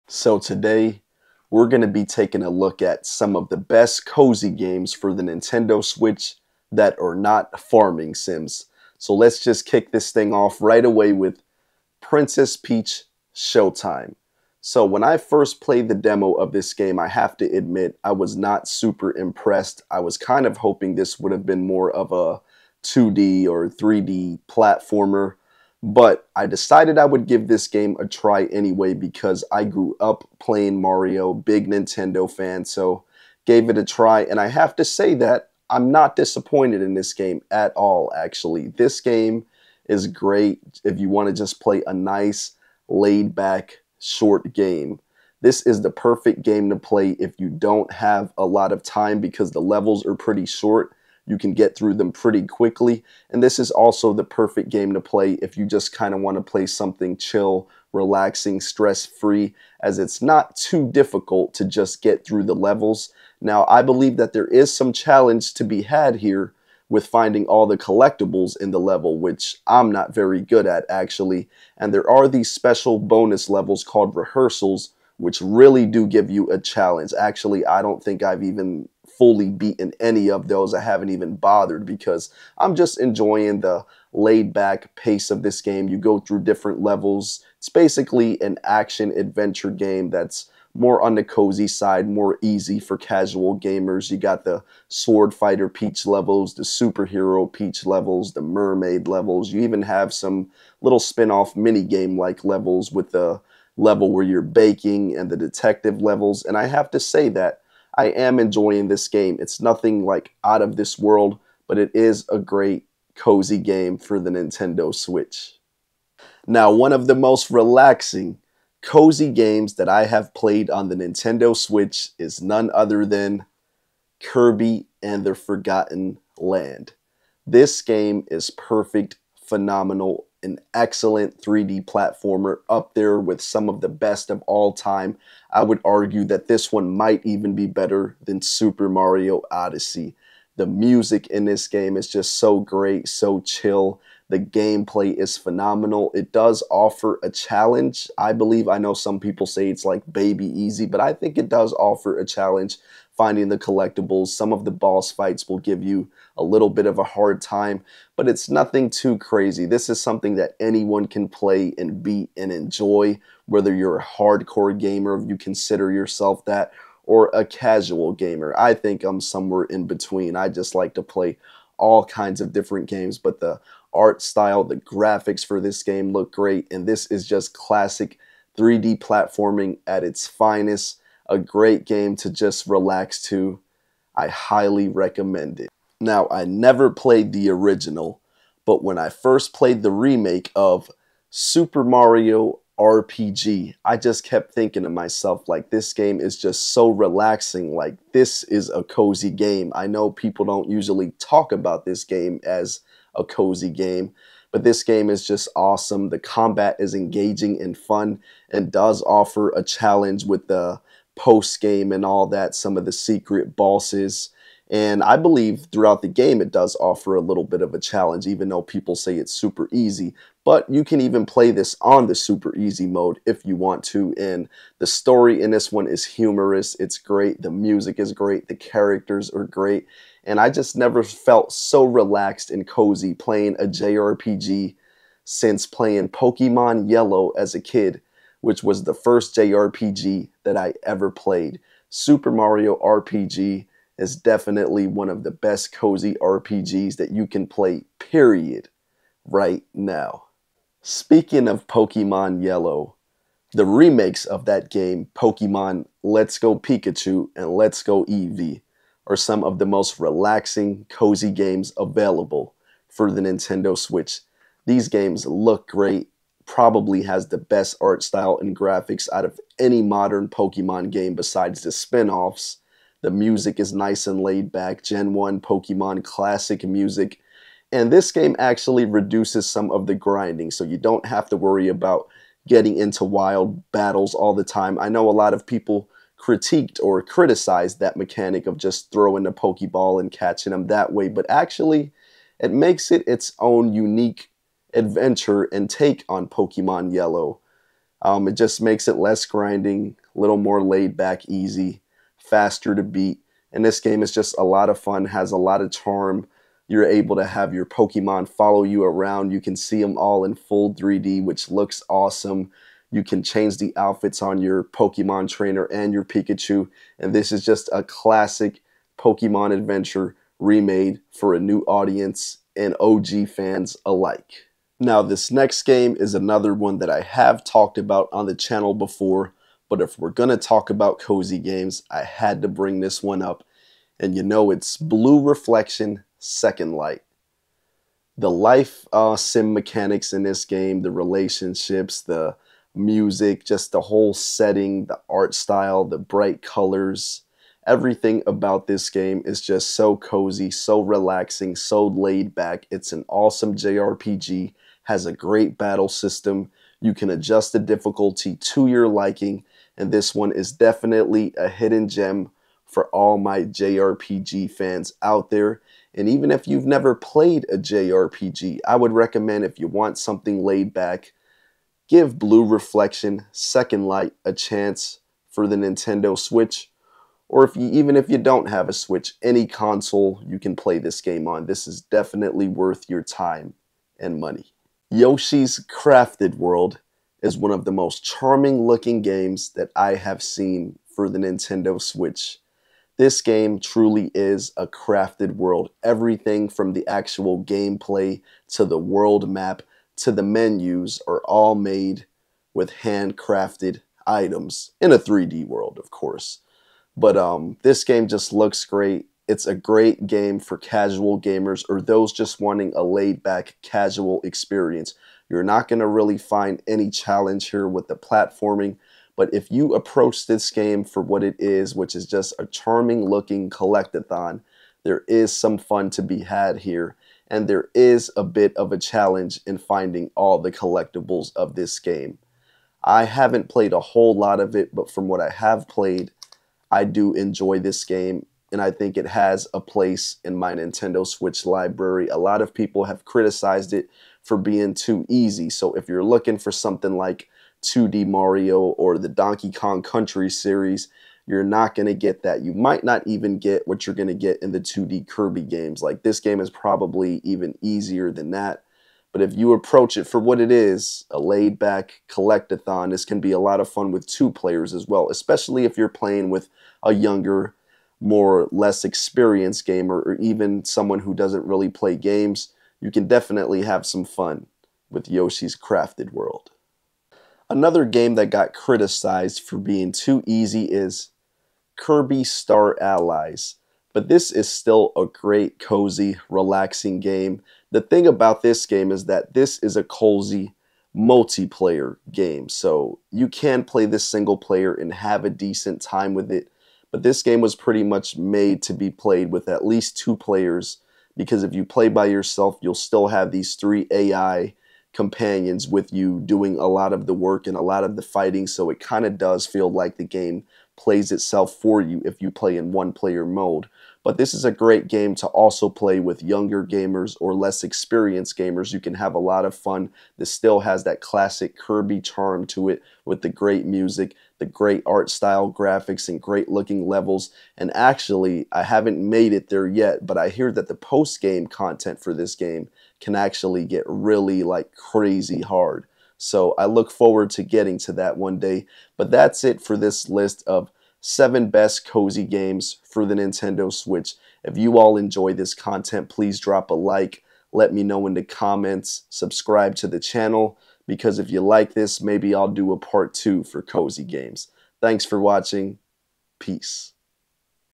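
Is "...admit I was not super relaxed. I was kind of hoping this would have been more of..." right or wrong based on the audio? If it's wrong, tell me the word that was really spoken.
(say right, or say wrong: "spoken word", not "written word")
wrong: "impressed", not "relaxed".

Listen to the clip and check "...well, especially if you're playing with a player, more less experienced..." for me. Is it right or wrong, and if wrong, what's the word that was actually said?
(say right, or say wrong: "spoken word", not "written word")
wrong: "younger", not "player".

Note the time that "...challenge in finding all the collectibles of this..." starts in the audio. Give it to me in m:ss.
7:08.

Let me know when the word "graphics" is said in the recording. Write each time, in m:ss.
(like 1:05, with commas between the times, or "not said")
2:54, 4:28, 8:45.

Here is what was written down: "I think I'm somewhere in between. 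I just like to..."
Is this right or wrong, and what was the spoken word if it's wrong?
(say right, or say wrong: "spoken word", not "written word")
right.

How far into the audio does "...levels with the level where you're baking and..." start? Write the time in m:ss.
1:42.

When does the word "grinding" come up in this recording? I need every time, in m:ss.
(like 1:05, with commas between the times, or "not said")
4:39, 4:59.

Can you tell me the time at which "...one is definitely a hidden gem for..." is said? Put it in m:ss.
6:00.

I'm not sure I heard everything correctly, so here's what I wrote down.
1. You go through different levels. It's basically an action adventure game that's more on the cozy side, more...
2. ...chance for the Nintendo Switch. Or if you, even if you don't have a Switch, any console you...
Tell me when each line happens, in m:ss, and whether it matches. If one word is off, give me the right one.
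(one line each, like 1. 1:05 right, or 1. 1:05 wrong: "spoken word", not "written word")
1. 1:25 right
2. 6:14 right.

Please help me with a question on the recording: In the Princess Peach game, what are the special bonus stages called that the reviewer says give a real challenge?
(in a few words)
Rehearsals.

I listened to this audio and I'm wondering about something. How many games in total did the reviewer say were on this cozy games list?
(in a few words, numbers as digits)
7.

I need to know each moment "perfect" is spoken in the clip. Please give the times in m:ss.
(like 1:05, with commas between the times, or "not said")
0:45, 0:54, 2:08.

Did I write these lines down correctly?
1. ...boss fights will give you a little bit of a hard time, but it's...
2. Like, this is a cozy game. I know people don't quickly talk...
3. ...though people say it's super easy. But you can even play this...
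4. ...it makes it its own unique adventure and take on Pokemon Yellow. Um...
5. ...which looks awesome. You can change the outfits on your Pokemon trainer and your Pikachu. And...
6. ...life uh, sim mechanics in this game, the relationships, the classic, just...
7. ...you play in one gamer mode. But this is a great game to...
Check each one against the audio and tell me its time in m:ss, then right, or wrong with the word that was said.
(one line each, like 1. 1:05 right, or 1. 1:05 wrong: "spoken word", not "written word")
1. 2:34 right
2. 3:17 wrong: "usually", not "quickly"
3. 3:38 right
4. 4:52 right
5. 5:11 right
6. 5:38 wrong: "music", not "classic"
7. 8:32 wrong: "player", not "gamer".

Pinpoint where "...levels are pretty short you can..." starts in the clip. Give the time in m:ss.
0:49.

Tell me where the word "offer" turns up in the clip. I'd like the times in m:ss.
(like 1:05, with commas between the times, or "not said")
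2:26, 2:31, 3:29, 3:36.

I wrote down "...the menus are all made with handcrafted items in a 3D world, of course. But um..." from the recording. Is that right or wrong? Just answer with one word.
right.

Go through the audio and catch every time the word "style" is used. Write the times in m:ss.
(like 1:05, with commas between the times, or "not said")
2:54, 4:28, 5:45, 8:45.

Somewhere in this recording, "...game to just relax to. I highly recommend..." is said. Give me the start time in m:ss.
3:01.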